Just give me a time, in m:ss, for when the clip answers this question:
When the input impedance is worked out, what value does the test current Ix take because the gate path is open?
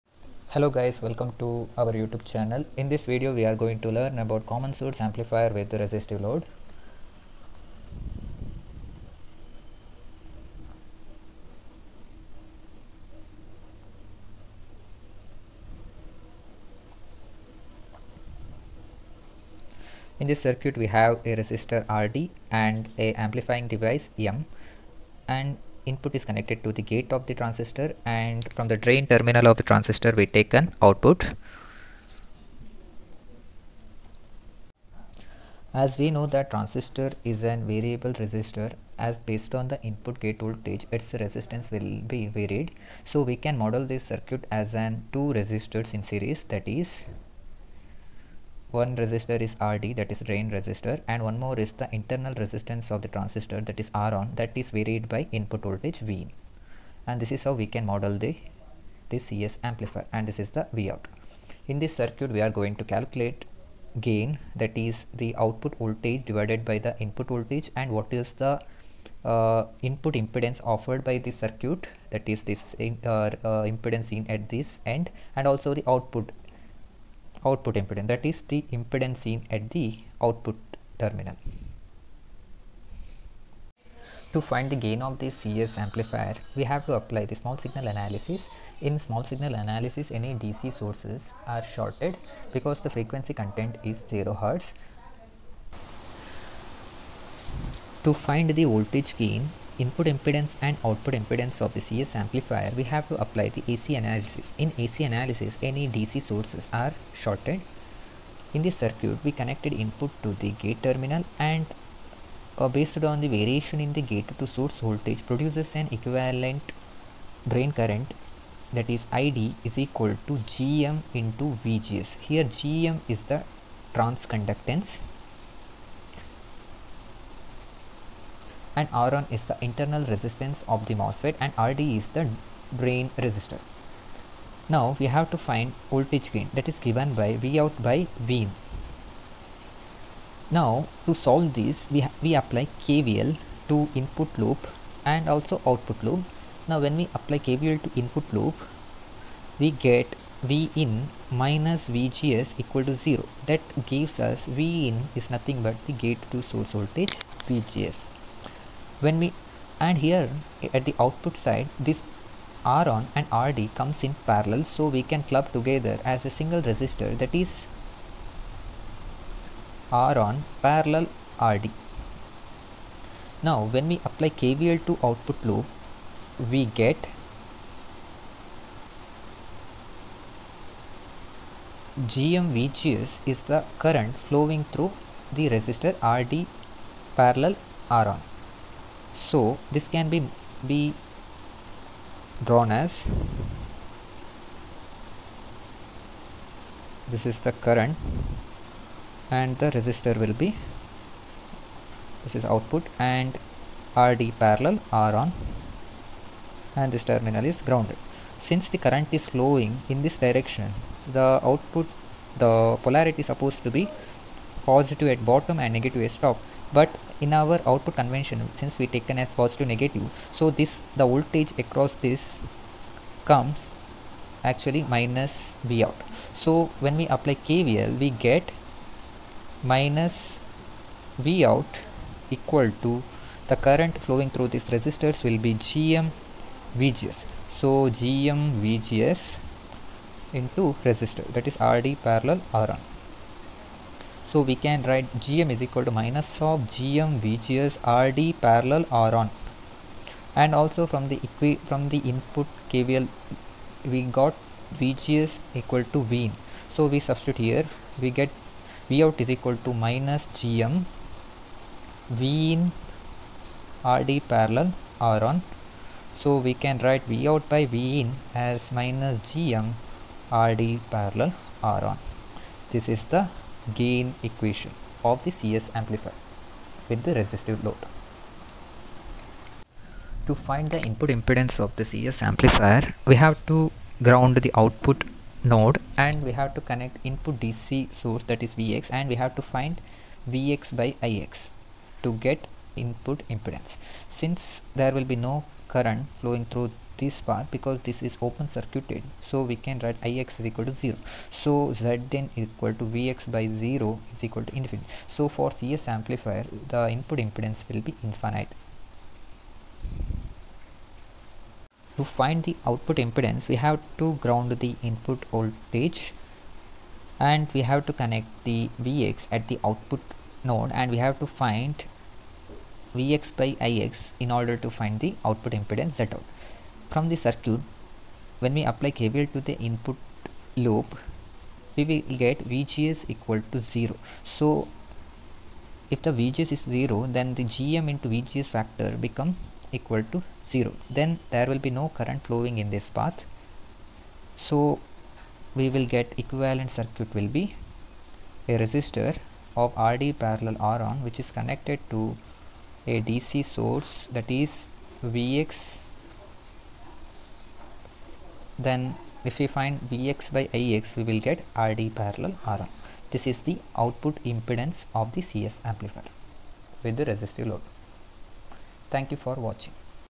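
5:00.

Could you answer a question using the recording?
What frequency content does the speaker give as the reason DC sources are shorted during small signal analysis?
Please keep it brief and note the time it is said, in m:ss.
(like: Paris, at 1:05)
0 Hz, at 1:34.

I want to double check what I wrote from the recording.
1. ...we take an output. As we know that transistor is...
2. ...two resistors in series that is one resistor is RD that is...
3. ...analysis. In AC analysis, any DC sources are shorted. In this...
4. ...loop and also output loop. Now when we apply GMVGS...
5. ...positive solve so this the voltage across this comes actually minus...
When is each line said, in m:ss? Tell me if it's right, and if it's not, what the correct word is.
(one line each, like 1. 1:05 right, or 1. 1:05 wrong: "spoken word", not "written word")
1. 0:30 right
2. 0:45 right
3. 1:43 right
4. 2:24 wrong: "KVL", not "GMVGS"
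5. 3:39 wrong: "negative", not "solve".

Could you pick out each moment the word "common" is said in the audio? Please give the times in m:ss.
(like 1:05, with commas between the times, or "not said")
0:04.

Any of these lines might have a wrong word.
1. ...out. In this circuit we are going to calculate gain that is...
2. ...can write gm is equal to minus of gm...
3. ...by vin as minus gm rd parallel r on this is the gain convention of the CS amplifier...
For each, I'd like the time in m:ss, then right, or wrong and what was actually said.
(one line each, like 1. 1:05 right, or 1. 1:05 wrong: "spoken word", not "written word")
1. 1:00 right
2. 4:04 right
3. 4:27 wrong: "equation", not "convention".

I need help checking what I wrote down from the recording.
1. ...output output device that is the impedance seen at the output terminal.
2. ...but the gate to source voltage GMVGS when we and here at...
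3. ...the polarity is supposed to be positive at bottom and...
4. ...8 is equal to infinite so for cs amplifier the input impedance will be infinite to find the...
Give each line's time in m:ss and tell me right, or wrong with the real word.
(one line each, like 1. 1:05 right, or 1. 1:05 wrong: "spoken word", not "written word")
1. 1:15 wrong: "impedance", not "device"
2. 2:35 wrong: "VGS", not "GMVGS"
3. 3:32 right
4. 5:03 wrong: "0", not "8".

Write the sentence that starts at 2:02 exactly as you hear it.
Here GM is the transconductance and r is the internal resistance of the MOSFET and RD is the drain resistor.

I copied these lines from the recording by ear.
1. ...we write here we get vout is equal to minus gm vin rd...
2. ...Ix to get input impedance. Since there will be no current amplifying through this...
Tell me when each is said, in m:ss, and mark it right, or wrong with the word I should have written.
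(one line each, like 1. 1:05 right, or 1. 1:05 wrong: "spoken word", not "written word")
1. 4:16 wrong: "substitute", not "write"
2. 4:51 wrong: "flowing", not "amplifying".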